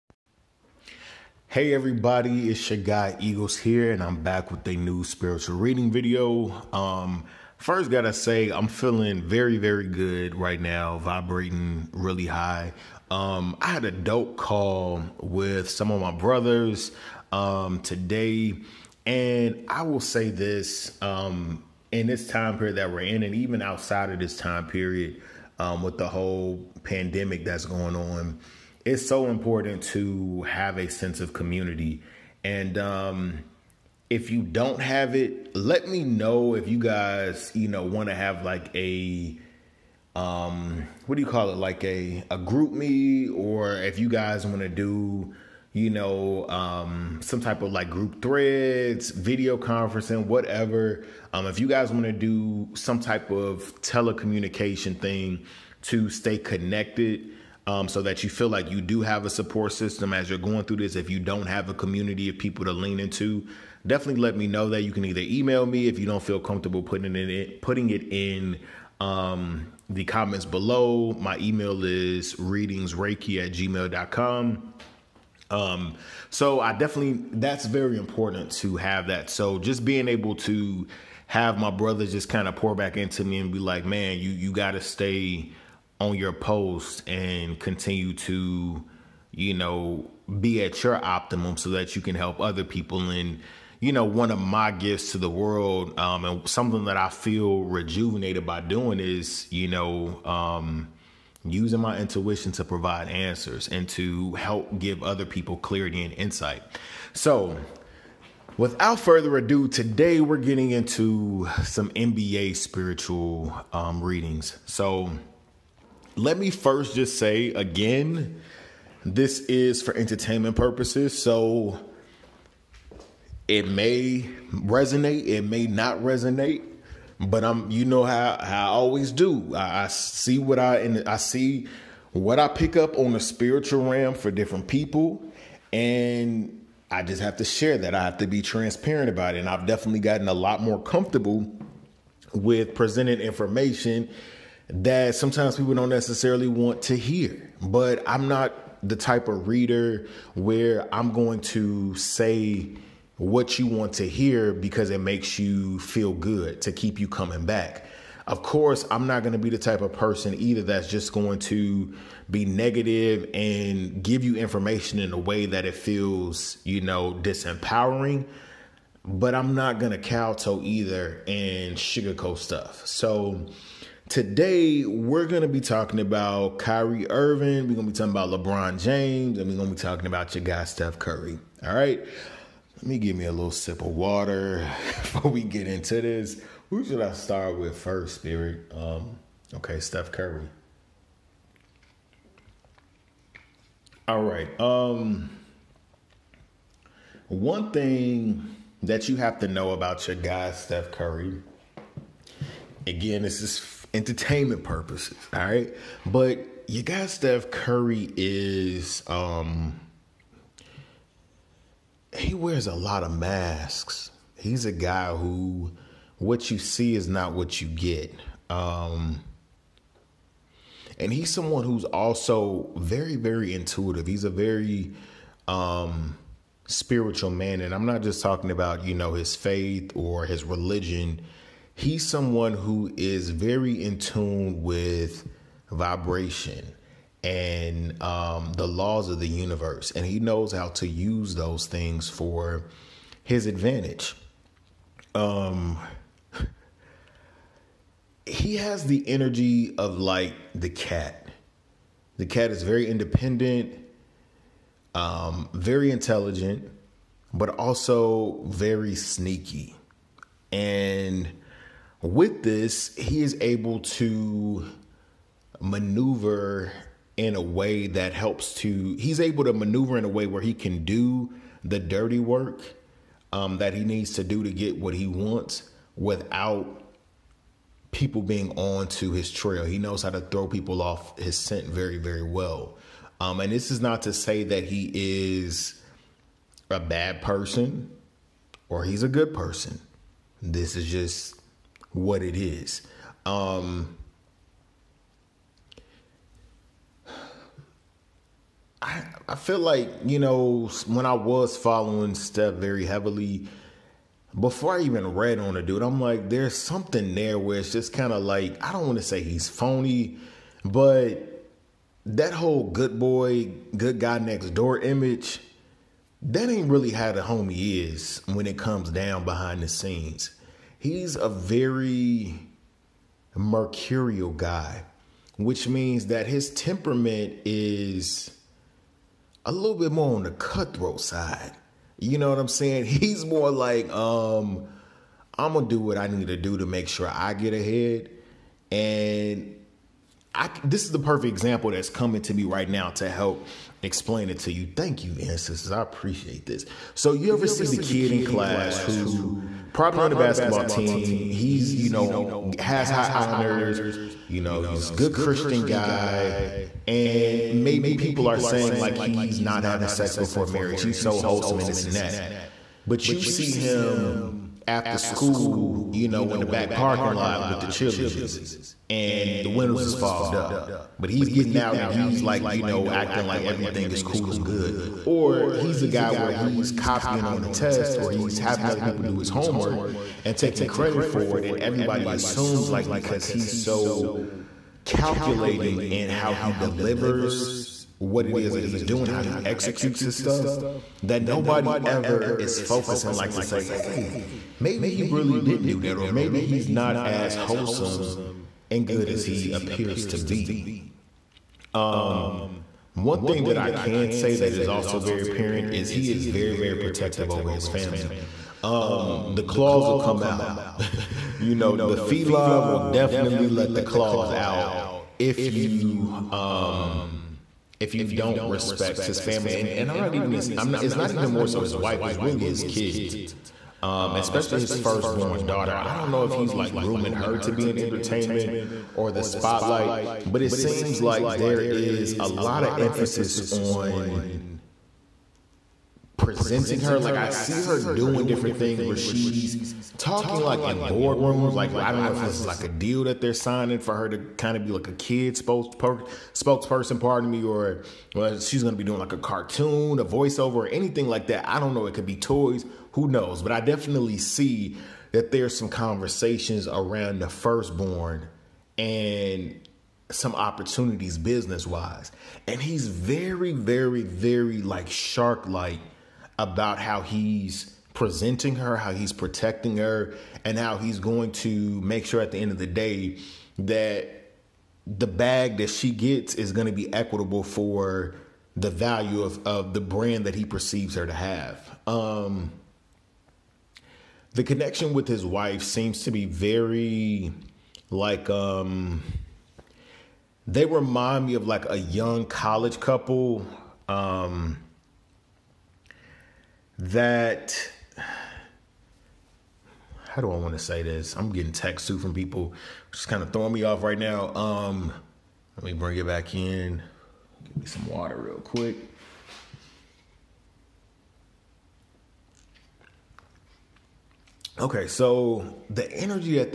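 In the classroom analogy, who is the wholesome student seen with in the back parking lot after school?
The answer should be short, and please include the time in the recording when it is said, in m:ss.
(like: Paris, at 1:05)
The cheerleaders, at 6:07.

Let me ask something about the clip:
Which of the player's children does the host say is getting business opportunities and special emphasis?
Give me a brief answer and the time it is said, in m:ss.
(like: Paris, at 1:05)
Firstborn daughter, at 7:04.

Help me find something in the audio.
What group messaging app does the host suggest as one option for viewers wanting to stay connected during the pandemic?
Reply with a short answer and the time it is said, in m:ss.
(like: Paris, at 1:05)
GroupMe, at 0:42.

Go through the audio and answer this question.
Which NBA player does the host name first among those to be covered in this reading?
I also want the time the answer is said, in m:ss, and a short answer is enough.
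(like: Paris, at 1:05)
Kyrie Irving, at 2:56.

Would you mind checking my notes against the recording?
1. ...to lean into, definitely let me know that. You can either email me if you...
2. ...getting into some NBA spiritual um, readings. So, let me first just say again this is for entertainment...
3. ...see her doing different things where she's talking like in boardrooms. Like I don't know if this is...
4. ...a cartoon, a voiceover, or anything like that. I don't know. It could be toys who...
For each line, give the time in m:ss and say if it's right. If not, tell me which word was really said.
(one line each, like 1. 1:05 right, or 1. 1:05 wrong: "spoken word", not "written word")
1. 1:02 right
2. 1:50 right
3. 7:17 right
4. 7:29 right.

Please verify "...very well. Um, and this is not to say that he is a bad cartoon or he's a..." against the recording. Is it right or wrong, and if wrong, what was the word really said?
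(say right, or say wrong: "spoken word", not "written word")
wrong: "person", not "cartoon".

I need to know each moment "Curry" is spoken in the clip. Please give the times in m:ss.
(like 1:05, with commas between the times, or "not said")
3:00, 3:10, 3:20, 3:27.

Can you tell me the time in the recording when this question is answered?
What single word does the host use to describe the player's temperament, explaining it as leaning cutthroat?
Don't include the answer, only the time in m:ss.
5:23.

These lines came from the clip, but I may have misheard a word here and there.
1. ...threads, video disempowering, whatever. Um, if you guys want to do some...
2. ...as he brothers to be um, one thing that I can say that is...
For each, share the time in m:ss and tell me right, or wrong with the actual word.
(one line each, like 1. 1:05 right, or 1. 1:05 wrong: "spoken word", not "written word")
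1. 0:48 wrong: "conferencing", not "disempowering"
2. 6:39 wrong: "appears", not "brothers".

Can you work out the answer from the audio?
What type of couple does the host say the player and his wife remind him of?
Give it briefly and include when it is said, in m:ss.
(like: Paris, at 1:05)
Young college couple, at 8:11.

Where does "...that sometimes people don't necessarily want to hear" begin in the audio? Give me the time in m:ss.
2:24.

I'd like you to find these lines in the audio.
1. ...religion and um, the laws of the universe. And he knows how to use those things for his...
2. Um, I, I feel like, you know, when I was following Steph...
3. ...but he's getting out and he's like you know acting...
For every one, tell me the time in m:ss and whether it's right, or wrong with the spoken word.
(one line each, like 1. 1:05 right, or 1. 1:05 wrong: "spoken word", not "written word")
1. 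3:55 wrong: "vibration", not "religion"
2. 4:53 right
3. 6:10 right.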